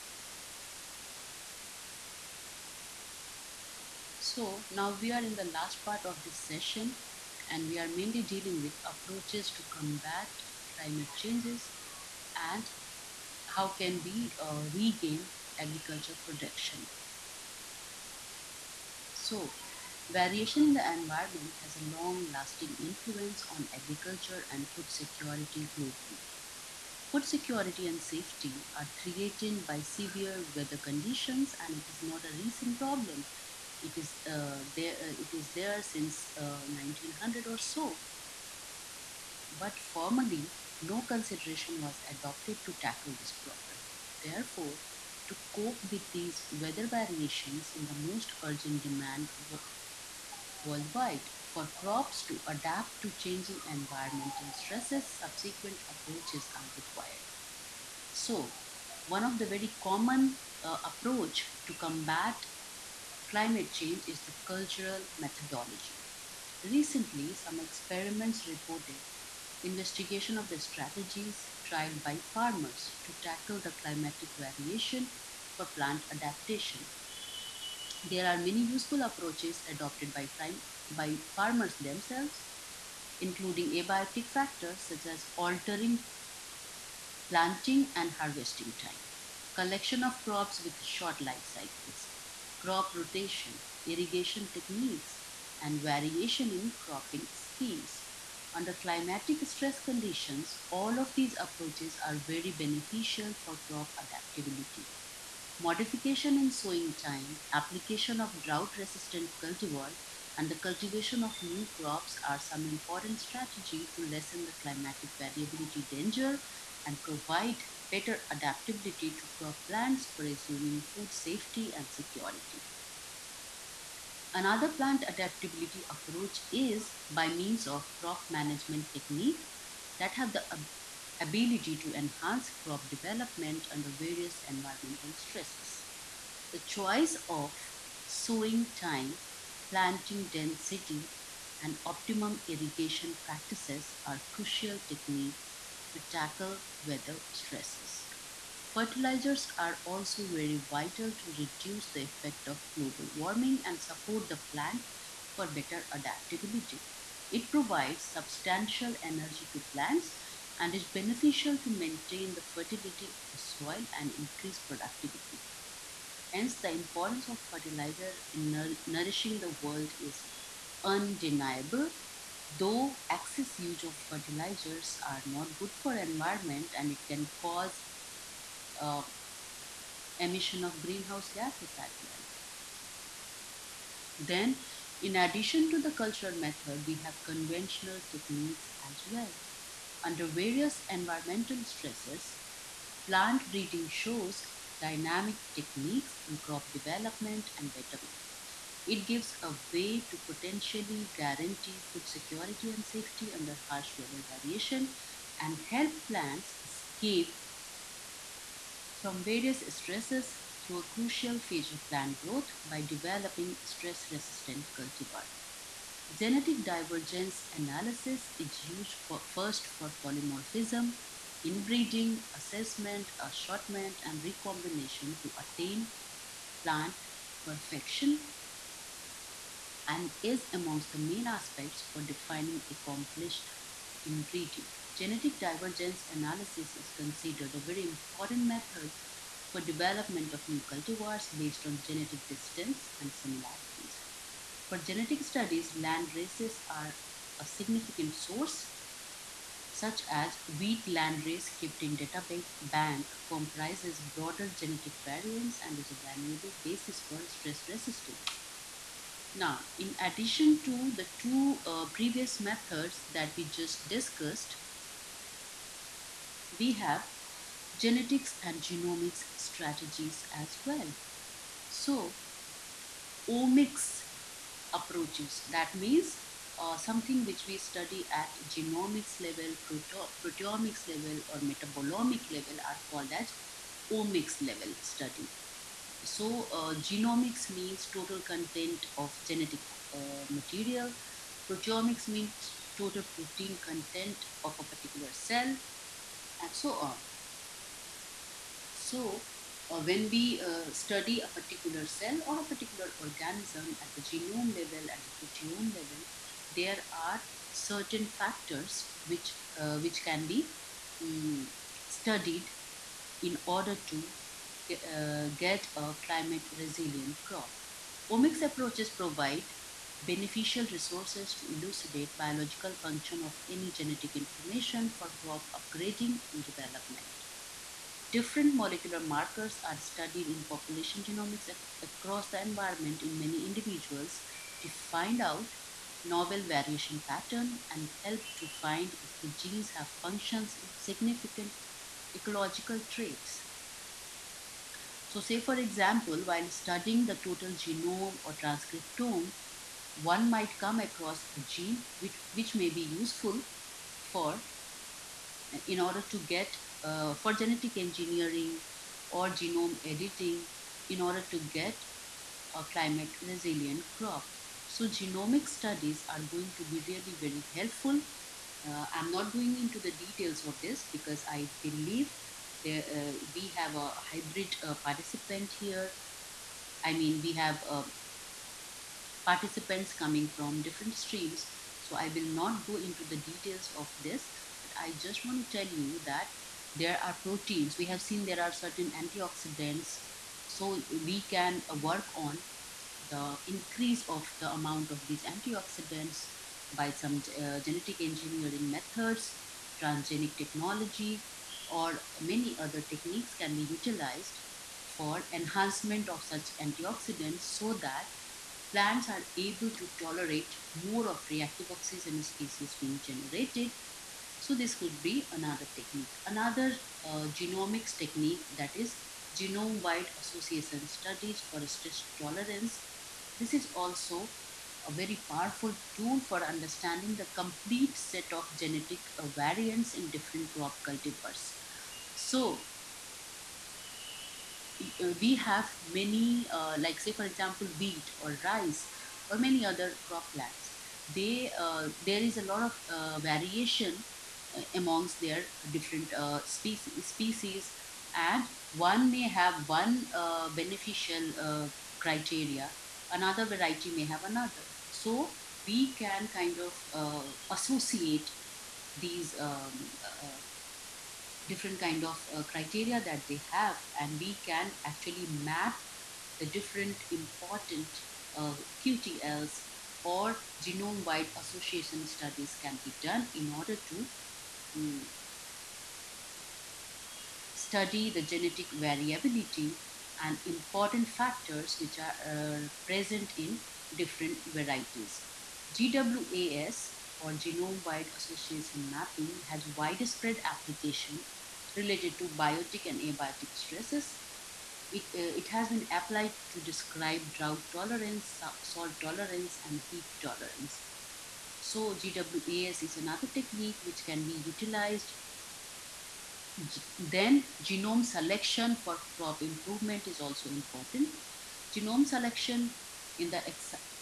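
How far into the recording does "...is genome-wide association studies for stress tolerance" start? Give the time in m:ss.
6:58.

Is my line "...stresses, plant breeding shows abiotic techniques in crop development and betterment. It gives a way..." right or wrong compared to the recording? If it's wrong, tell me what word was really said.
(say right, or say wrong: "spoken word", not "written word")
wrong: "dynamic", not "abiotic".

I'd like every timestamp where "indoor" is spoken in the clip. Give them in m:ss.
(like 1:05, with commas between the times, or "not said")
not said.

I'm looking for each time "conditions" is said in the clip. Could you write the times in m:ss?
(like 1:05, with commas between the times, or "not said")
0:30, 1:39.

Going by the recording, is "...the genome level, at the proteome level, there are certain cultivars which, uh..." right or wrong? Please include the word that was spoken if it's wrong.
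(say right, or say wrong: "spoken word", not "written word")
wrong: "factors", not "cultivars".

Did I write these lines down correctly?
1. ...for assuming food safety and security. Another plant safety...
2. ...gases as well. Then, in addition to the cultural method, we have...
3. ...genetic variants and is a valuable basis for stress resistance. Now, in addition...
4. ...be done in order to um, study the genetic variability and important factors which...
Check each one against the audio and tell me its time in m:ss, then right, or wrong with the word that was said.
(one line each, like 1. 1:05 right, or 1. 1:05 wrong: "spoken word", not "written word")
1. 2:00 wrong: "adaptability", not "safety"
2. 3:01 right
3. 4:14 right
4. 7:52 right.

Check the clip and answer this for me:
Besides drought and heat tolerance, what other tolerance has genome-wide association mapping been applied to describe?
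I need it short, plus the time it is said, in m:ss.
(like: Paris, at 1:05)
Salt tolerance, at 8:18.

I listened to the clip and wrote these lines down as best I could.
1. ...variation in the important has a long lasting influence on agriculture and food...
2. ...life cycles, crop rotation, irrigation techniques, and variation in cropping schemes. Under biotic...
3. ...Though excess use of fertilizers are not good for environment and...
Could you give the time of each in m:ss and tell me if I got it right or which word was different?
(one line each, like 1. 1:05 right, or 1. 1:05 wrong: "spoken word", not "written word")
1. 0:20 wrong: "environment", not "important"
2. 1:31 wrong: "climatic", not "biotic"
3. 2:52 right.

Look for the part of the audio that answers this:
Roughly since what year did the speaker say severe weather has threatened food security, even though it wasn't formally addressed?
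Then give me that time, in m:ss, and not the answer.
0:36.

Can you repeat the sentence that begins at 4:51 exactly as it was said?
Proteomics means total protein content of a particular cell and so on.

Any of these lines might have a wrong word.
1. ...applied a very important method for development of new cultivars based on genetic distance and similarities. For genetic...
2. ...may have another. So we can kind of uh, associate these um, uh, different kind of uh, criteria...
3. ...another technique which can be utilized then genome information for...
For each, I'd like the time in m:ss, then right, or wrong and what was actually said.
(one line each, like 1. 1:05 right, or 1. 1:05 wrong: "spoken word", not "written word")
1. 3:56 wrong: "considered", not "applied"
2. 7:33 right
3. 8:22 wrong: "selection", not "information".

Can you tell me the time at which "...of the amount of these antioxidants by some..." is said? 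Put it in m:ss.
6:34.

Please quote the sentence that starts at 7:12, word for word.
So uh, we have many, uh, like say for example, wheat or rice or many other crop plants.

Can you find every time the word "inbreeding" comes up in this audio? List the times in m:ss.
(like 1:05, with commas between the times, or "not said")
3:41, 3:54.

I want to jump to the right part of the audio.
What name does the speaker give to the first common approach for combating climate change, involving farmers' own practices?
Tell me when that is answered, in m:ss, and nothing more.
1:04.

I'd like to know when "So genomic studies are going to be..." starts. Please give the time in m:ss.
6:04.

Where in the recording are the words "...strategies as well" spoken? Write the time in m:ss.
4:29.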